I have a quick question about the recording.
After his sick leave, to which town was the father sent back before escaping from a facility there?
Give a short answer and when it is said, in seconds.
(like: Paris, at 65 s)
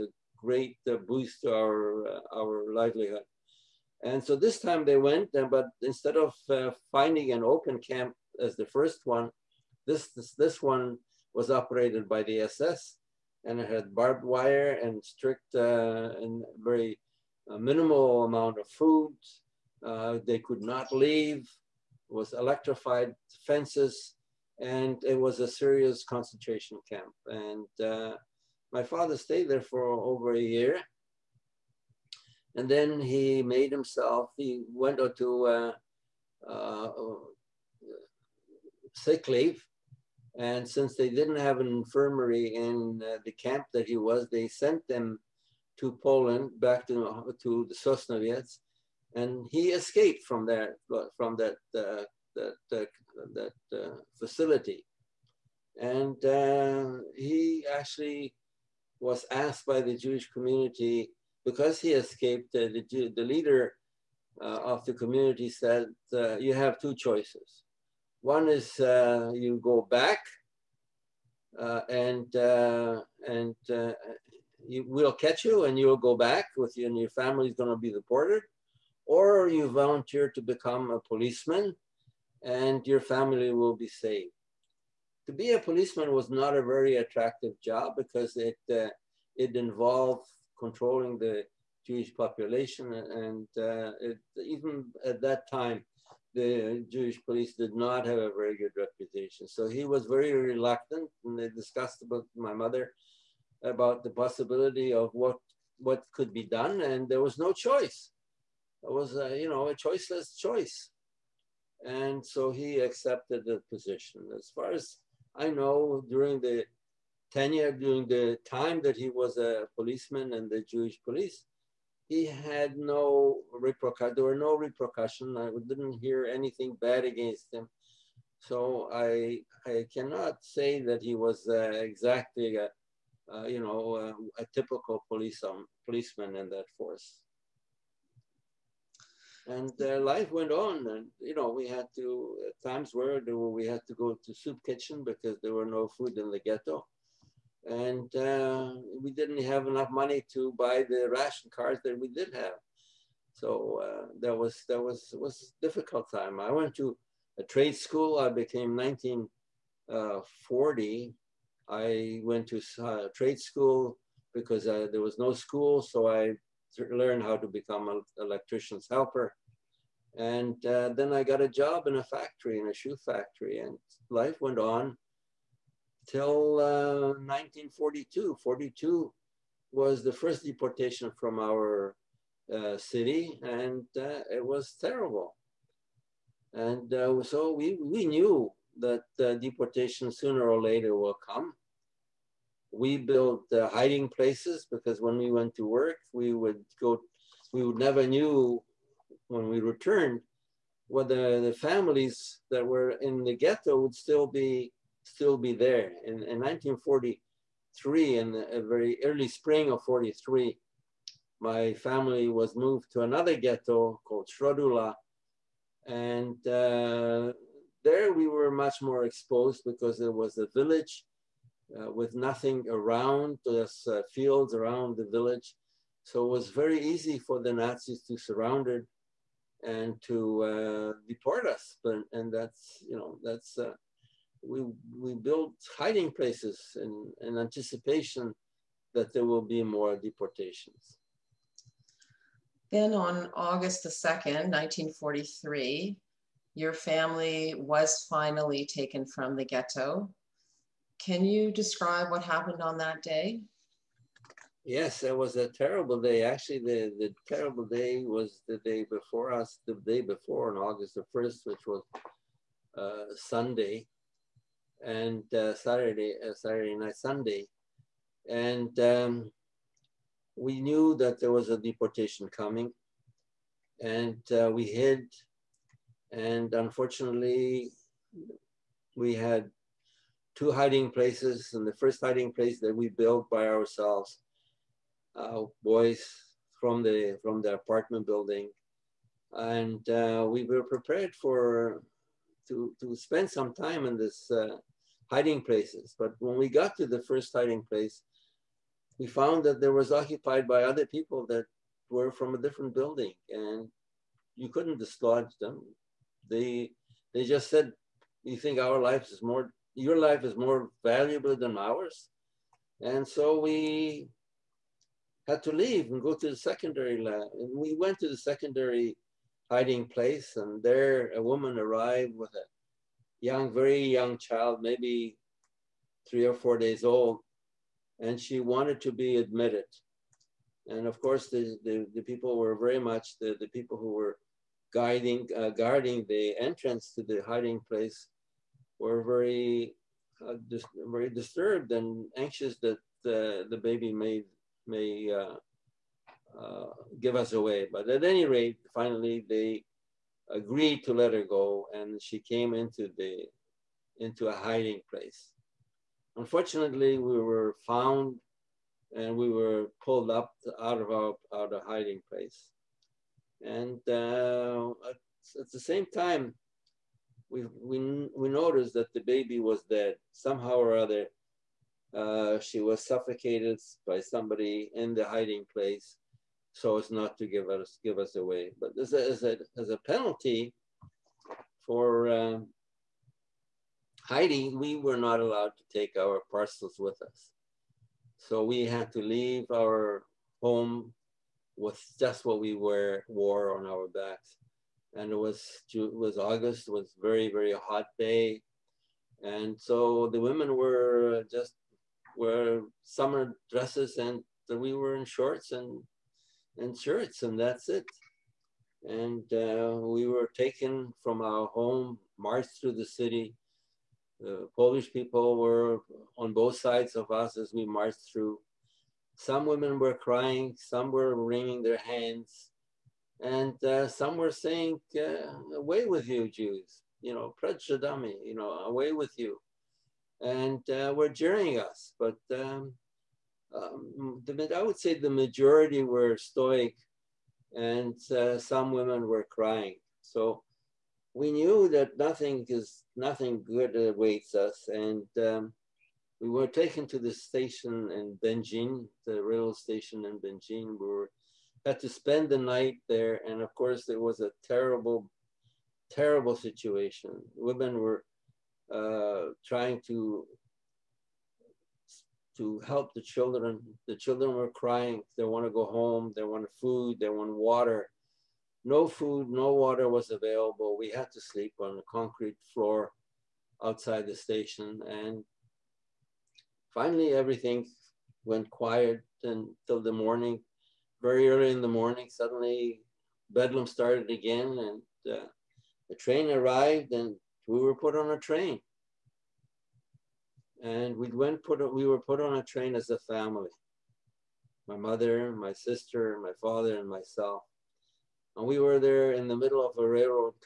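Sosnowiec, at 47 s.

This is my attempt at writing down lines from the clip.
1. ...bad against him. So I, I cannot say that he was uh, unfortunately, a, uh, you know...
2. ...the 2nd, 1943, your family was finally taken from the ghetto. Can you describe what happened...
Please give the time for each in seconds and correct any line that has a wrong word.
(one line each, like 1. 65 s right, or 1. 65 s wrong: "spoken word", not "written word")
1. 126 s wrong: "exactly", not "unfortunately"
2. 243 s right.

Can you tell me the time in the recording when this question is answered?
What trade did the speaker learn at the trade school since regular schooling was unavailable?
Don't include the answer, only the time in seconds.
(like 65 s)
168 s.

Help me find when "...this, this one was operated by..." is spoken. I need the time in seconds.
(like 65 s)
10 s.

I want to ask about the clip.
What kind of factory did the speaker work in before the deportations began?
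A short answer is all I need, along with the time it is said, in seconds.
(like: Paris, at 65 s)
Shoe factory, at 172 s.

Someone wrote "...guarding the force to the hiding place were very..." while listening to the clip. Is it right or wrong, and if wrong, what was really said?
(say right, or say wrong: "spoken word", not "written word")
wrong: "entrance", not "force".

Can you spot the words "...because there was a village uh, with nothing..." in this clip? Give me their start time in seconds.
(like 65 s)
219 s.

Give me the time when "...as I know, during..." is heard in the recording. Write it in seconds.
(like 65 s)
114 s.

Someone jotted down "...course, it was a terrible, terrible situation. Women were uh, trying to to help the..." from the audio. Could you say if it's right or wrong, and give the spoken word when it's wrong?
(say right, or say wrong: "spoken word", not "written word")
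right.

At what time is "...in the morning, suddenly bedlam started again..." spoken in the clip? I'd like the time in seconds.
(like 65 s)
481 s.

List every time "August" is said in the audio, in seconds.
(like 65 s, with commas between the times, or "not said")
243 s, 260 s, 396 s.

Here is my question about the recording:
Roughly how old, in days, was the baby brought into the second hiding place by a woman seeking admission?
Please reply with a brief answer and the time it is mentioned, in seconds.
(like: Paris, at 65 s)
3 or 4 days, at 326 s.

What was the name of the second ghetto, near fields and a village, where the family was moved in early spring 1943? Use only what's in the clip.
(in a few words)
Środula.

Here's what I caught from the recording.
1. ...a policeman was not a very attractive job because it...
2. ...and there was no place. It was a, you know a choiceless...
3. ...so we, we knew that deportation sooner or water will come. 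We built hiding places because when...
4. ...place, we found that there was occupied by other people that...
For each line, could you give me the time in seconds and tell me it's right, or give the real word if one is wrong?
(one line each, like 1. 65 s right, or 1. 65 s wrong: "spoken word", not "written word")
1. 85 s right
2. 106 s wrong: "choice", not "place"
3. 187 s wrong: "later", not "water"
4. 297 s right.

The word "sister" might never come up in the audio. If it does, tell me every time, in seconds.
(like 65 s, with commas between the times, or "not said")
495 s.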